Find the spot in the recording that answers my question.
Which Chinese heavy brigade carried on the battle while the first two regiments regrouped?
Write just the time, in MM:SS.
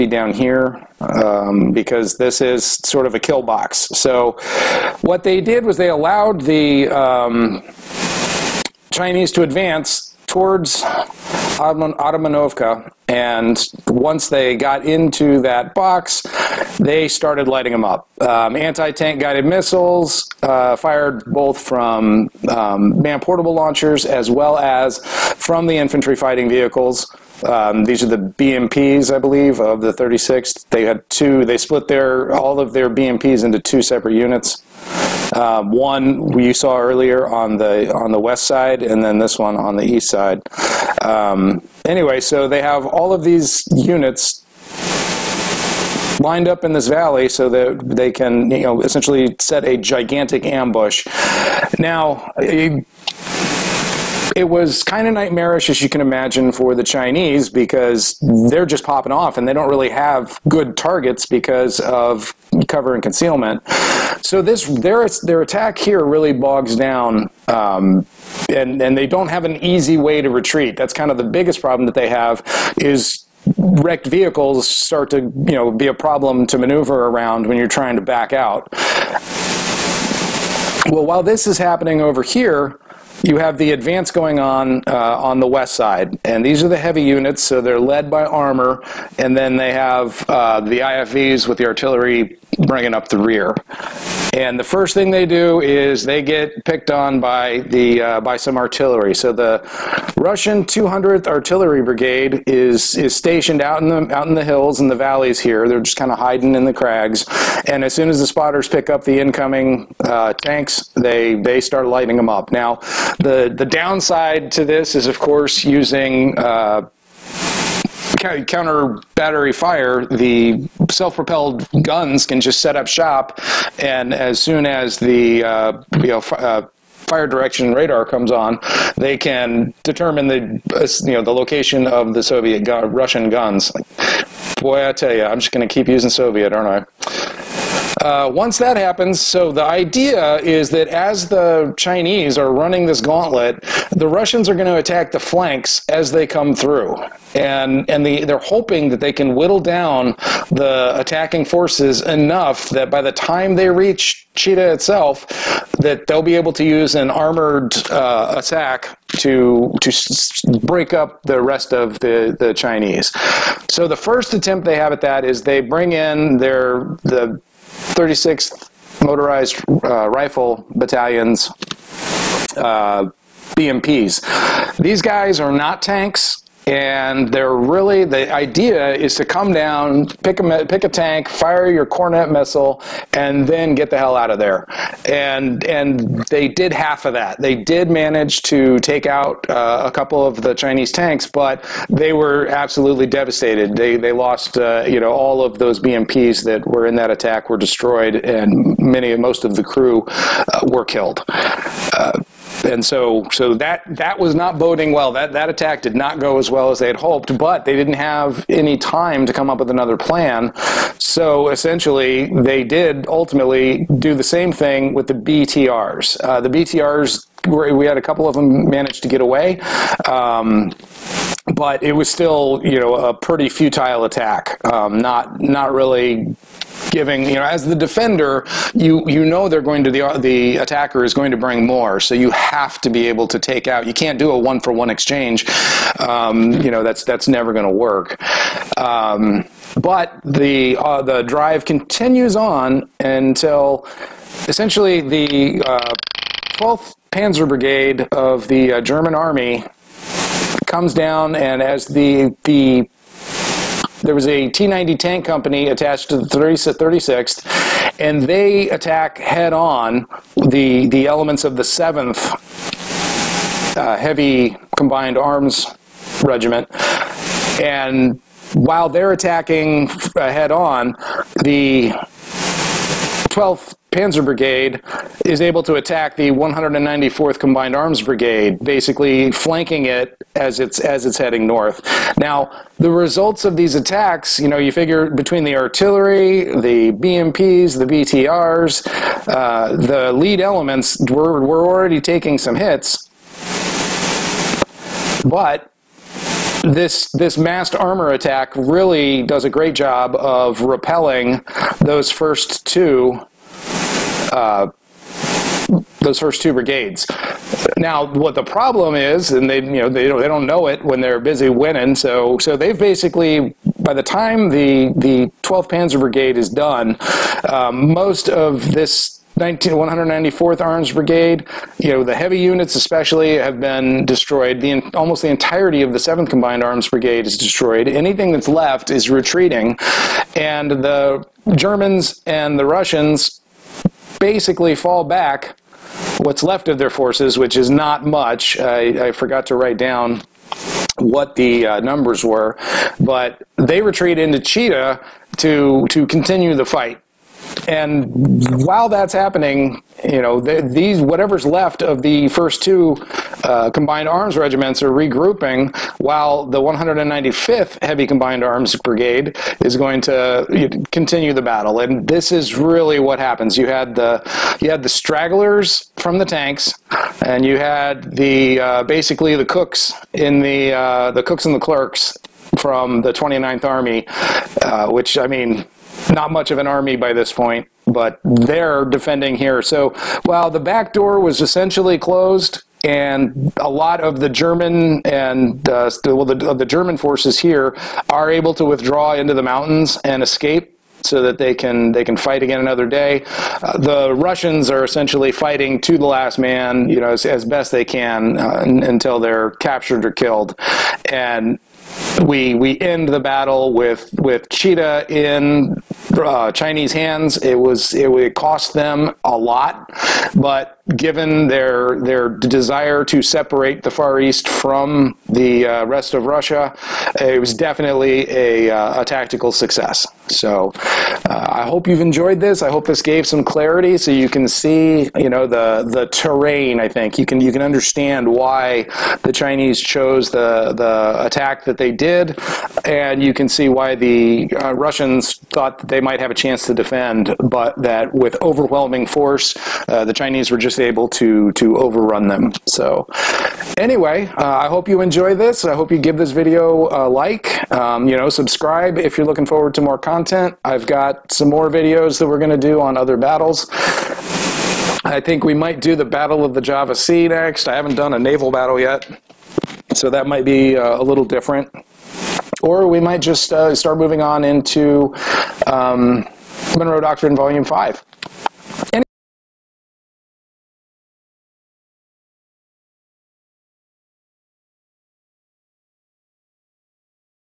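05:56.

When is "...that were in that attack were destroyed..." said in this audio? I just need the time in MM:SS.
03:16.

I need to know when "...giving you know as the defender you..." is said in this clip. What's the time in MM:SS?
03:46.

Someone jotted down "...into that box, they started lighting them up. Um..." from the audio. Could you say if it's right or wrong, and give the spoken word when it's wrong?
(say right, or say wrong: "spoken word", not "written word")
right.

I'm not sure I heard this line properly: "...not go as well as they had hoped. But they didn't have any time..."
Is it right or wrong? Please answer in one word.
right.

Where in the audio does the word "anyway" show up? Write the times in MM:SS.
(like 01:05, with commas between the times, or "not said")
00:41, 07:23.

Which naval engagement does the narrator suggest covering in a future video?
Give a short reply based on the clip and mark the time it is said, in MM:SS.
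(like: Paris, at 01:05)
Battle of the Java Sea, at 07:36.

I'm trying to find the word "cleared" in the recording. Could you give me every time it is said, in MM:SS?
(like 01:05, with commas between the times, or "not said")
not said.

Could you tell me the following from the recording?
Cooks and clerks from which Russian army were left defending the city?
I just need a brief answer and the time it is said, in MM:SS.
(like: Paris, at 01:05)
29th Army, at 06:13.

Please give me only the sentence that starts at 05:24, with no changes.
The almost the entirety of the 7th Combined Arms Brigade is destroyed.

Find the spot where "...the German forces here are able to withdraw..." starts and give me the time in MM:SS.
06:26.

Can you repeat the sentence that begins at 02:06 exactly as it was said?
Uh, fire direction radar comes on, they can determine the uh, you know the location of the Soviet gu Russian guns.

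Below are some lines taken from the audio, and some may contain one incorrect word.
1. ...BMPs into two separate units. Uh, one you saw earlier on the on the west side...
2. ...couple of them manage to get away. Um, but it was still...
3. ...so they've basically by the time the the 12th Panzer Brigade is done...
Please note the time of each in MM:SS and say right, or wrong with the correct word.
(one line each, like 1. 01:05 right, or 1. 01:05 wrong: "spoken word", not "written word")
1. 00:32 right
2. 03:38 right
3. 05:12 right.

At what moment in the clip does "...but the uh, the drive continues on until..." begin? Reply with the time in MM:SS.
03:59.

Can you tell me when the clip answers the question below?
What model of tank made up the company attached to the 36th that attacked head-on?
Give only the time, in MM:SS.
04:14.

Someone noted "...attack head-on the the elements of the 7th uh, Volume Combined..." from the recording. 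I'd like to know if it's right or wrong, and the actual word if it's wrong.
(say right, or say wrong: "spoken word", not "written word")
wrong: "Heavy", not "Volume".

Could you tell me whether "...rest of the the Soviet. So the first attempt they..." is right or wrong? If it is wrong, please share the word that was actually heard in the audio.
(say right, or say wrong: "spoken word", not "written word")
wrong: "Chinese", not "Soviet".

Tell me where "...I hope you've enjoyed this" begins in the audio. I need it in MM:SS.
07:01.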